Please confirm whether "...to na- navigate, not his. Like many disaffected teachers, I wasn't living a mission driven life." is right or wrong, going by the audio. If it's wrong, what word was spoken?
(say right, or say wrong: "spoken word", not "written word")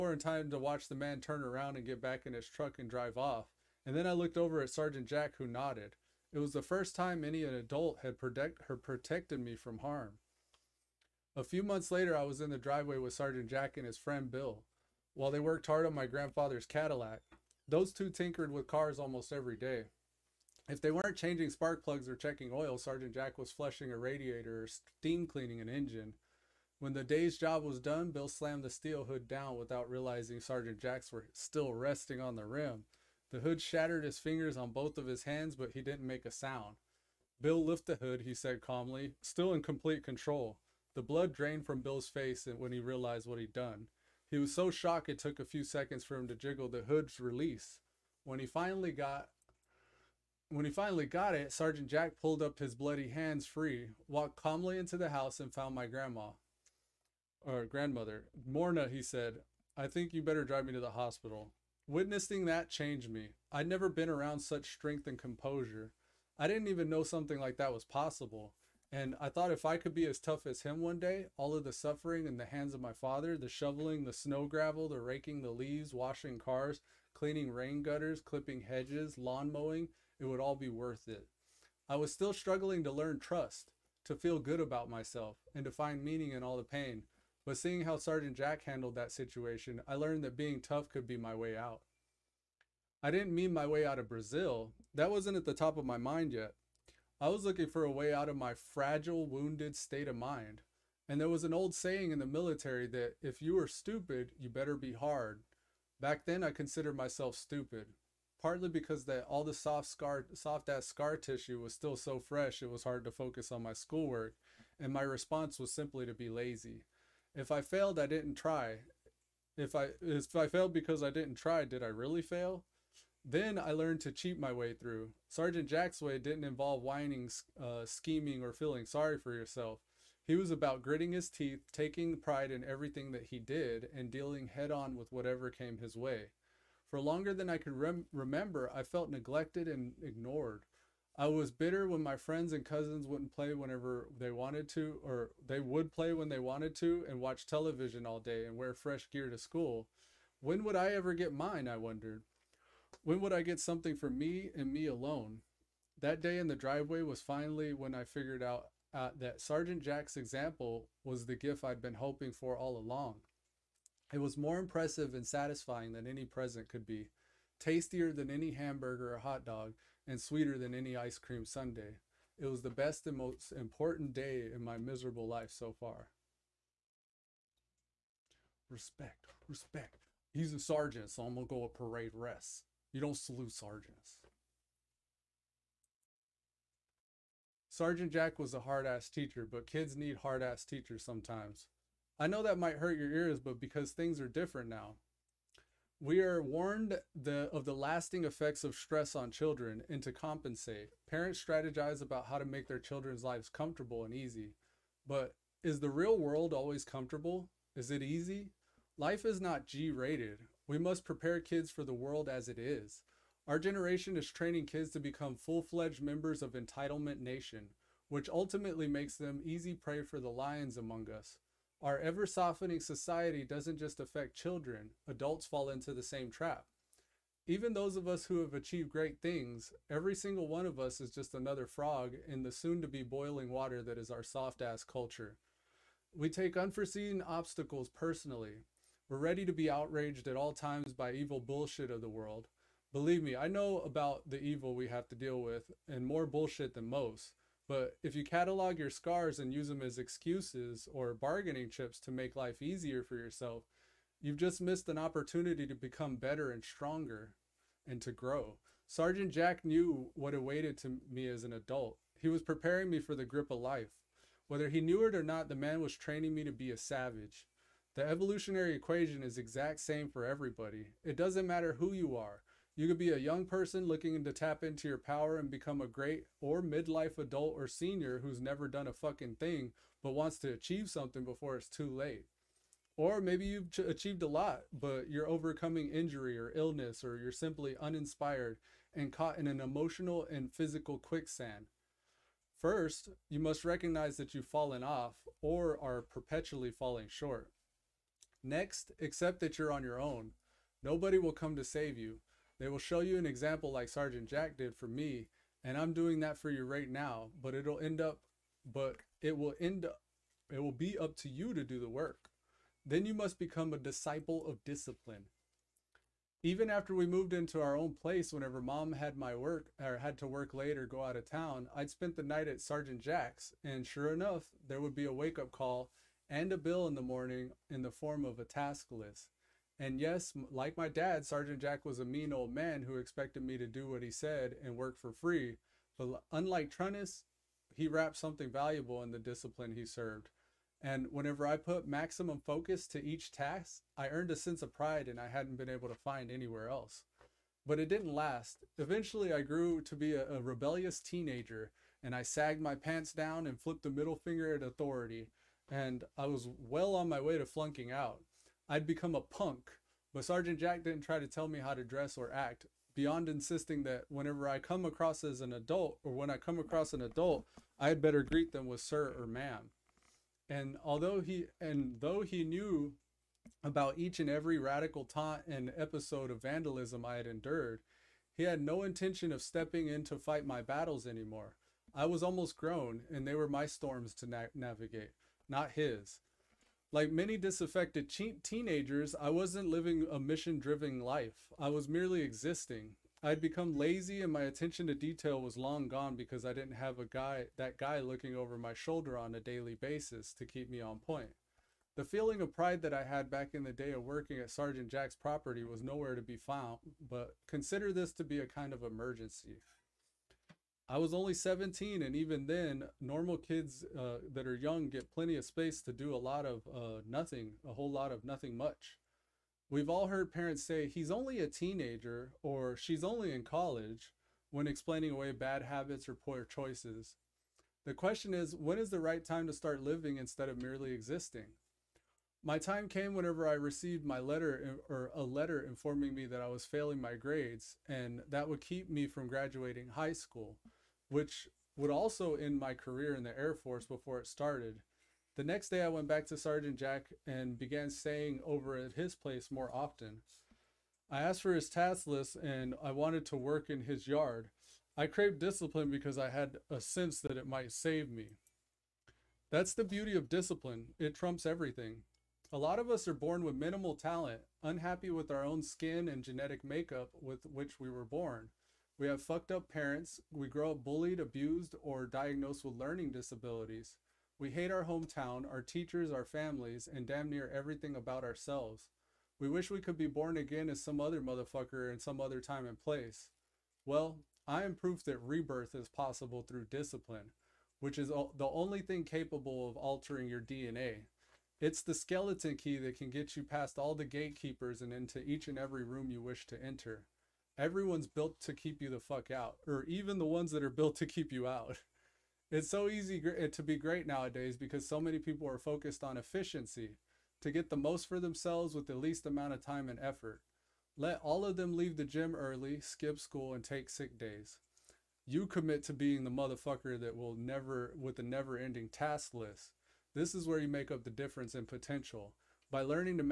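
wrong: "teenagers", not "teachers".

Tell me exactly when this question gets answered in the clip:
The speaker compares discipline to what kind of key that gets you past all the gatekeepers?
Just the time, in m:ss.
8:11.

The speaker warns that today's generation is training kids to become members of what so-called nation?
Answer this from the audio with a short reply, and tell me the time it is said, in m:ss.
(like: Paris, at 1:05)
Entitlement Nation, at 3:36.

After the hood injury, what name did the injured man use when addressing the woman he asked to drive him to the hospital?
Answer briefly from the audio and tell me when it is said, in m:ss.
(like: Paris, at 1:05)
Morna, at 0:58.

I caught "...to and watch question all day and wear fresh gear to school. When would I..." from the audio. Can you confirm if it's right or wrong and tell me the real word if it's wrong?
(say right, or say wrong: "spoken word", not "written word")
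wrong: "television", not "question".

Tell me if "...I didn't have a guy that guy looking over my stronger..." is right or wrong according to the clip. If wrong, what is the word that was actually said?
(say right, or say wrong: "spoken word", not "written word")
wrong: "shoulder", not "stronger".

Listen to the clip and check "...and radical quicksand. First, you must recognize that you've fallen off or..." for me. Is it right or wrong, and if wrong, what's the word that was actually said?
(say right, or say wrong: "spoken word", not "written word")
wrong: "physical", not "radical".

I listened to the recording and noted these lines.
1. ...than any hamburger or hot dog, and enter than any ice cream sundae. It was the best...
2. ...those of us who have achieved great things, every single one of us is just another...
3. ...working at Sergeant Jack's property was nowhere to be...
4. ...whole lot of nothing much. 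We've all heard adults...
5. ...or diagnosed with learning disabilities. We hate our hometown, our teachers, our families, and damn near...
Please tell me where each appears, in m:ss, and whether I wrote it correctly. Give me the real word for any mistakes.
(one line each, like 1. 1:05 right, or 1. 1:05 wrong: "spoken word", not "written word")
1. 2:48 wrong: "sweeter", not "enter"
2. 3:47 right
3. 6:44 right
4. 6:57 wrong: "parents", not "adults"
5. 7:51 right.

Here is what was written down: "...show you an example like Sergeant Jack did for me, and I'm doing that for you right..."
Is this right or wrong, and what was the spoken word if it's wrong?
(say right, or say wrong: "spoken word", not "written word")
right.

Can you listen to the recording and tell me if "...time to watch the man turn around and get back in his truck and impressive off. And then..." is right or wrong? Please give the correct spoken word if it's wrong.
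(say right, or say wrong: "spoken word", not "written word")
wrong: "drive", not "impressive".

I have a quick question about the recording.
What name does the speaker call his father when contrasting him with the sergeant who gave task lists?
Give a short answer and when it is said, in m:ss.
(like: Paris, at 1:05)
Trunnis, at 5:36.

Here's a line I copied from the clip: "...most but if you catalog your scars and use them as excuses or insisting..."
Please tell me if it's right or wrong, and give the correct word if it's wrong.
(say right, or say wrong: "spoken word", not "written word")
wrong: "bargaining", not "insisting".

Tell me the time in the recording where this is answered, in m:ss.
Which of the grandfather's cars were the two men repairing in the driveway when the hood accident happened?
0:16.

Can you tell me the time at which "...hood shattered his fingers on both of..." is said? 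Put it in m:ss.
0:33.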